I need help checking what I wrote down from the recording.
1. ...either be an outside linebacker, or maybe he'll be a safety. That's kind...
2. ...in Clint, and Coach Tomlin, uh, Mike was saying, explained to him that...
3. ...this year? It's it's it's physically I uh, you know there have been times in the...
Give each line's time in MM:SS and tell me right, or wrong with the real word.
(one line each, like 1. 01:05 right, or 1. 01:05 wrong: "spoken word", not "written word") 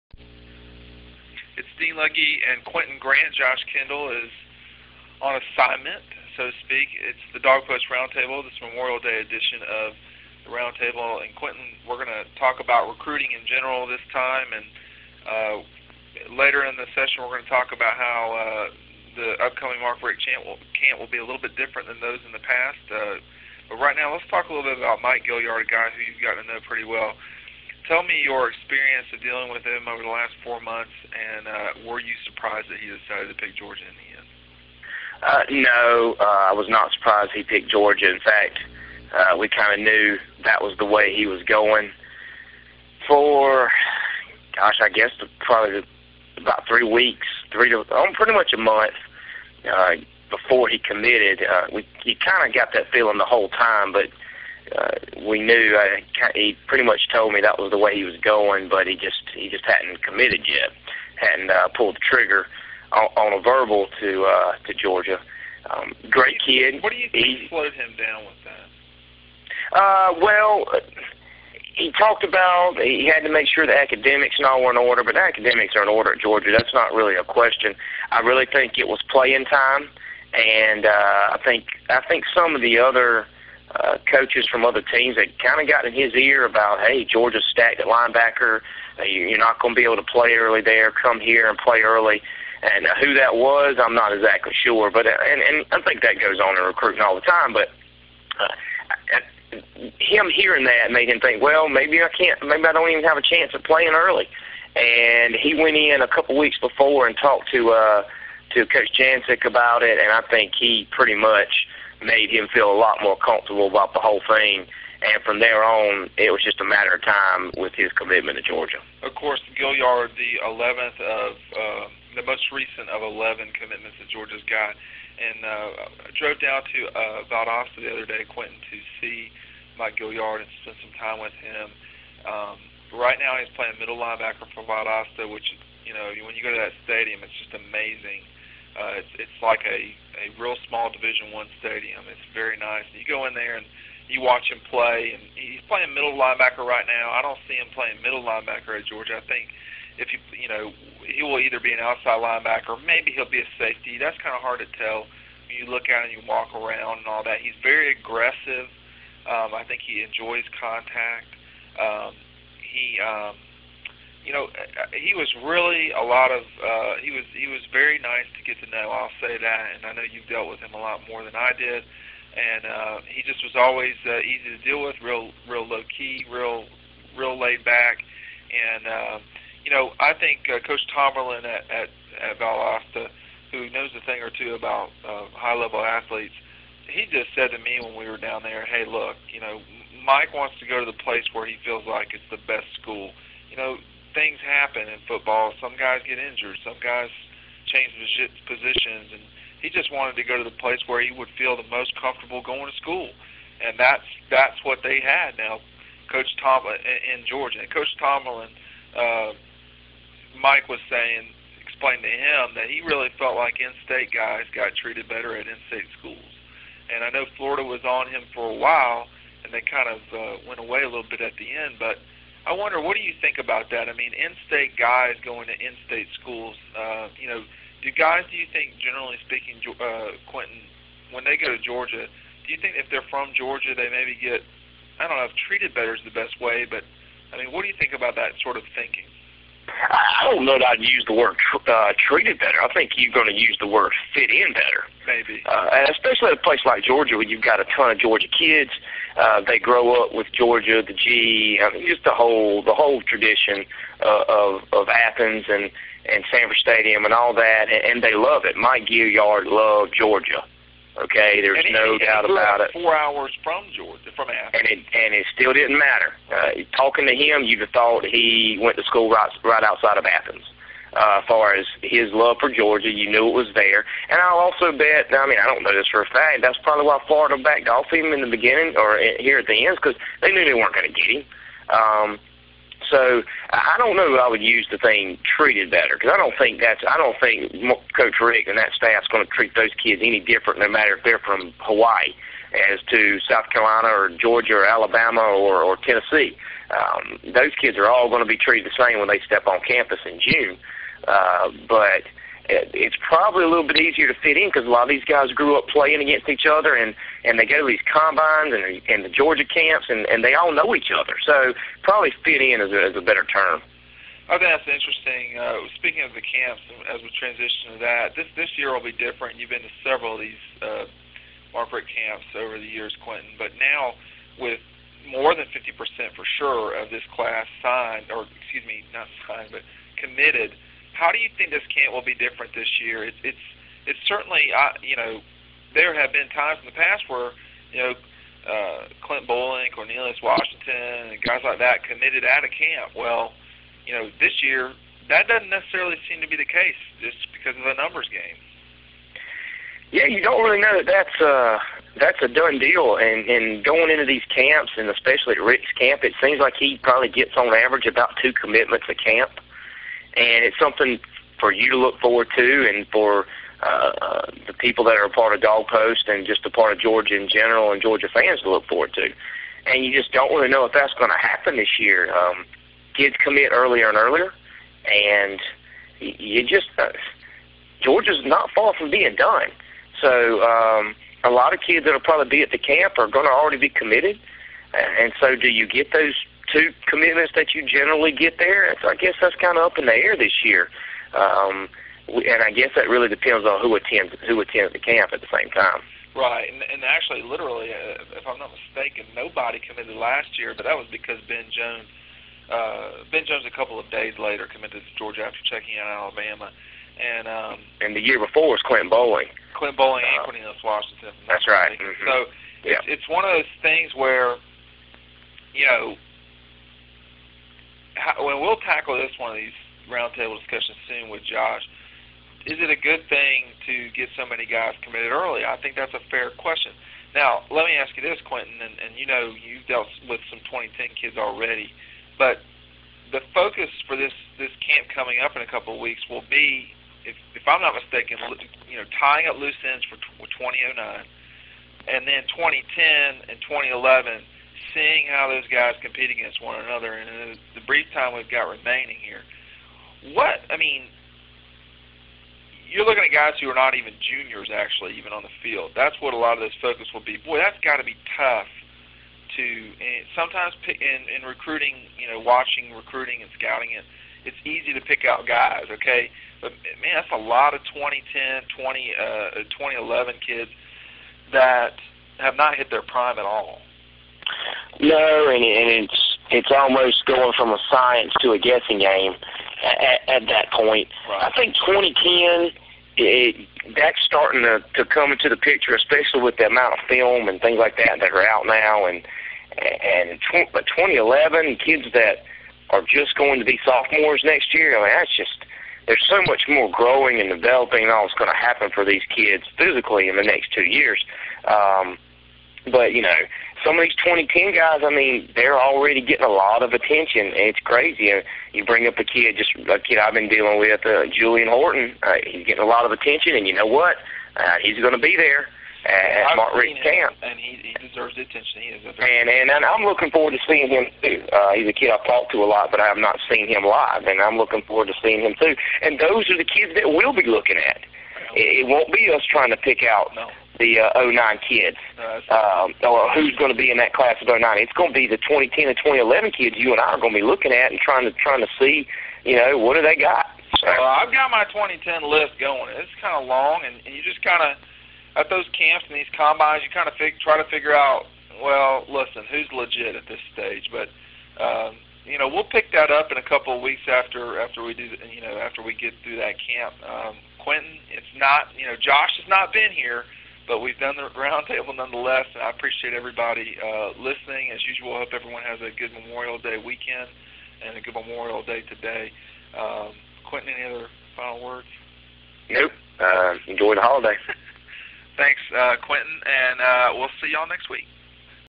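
1. 02:31 right
2. 03:27 wrong: "Georgia", not "Clint"
3. 05:32 wrong: "certainly", not "physically".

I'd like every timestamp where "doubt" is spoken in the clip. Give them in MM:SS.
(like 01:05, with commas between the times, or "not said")
04:22.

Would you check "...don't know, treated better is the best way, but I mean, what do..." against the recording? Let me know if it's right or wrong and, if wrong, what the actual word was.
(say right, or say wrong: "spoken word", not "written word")
right.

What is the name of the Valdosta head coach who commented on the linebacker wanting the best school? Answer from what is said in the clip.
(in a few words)
Coach Tomberlin.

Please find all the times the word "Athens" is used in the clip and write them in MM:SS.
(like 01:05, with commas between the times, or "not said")
04:14, 04:24, 04:30.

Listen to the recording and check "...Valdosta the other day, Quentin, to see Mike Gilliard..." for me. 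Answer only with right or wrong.
right.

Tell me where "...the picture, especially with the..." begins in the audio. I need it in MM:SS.
08:05.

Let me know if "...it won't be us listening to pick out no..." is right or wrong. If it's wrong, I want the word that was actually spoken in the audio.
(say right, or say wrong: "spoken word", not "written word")
wrong: "trying", not "listening".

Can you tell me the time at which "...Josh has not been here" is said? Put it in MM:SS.
09:18.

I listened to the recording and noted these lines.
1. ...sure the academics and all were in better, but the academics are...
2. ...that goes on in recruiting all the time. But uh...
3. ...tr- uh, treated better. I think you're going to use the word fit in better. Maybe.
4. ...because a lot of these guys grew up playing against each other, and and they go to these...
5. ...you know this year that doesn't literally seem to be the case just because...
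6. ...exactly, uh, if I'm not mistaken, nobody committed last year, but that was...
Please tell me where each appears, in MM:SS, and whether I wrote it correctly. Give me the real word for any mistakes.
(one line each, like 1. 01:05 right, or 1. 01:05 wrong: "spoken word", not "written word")
1. 01:13 wrong: "order", not "better"
2. 01:36 right
3. 04:01 right
4. 05:04 right
5. 05:43 wrong: "necessarily", not "literally"
6. 06:37 wrong: "literally", not "exactly".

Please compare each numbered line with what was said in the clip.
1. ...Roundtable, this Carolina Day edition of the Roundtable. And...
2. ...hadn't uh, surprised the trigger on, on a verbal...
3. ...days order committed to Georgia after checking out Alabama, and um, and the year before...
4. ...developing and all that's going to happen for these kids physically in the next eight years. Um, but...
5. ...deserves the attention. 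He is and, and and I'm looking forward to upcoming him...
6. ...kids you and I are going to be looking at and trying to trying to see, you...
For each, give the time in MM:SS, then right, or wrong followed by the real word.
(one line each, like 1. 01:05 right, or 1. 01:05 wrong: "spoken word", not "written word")
1. 00:07 wrong: "Memorial", not "Carolina"
2. 01:01 wrong: "pulled", not "surprised"
3. 06:43 wrong: "later", not "order"
4. 08:17 wrong: "two", not "eight"
5. 08:37 wrong: "seeing", not "upcoming"
6. 08:56 right.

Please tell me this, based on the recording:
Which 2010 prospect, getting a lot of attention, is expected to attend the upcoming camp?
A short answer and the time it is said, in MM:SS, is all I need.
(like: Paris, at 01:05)
Julian Horton, at 08:31.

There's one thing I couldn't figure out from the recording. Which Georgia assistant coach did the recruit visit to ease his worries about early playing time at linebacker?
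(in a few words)
Coach Jancek.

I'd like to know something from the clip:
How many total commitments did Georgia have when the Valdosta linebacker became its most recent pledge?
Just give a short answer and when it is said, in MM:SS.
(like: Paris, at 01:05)
11, at 02:03.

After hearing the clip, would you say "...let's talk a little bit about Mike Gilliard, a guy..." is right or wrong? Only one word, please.
right.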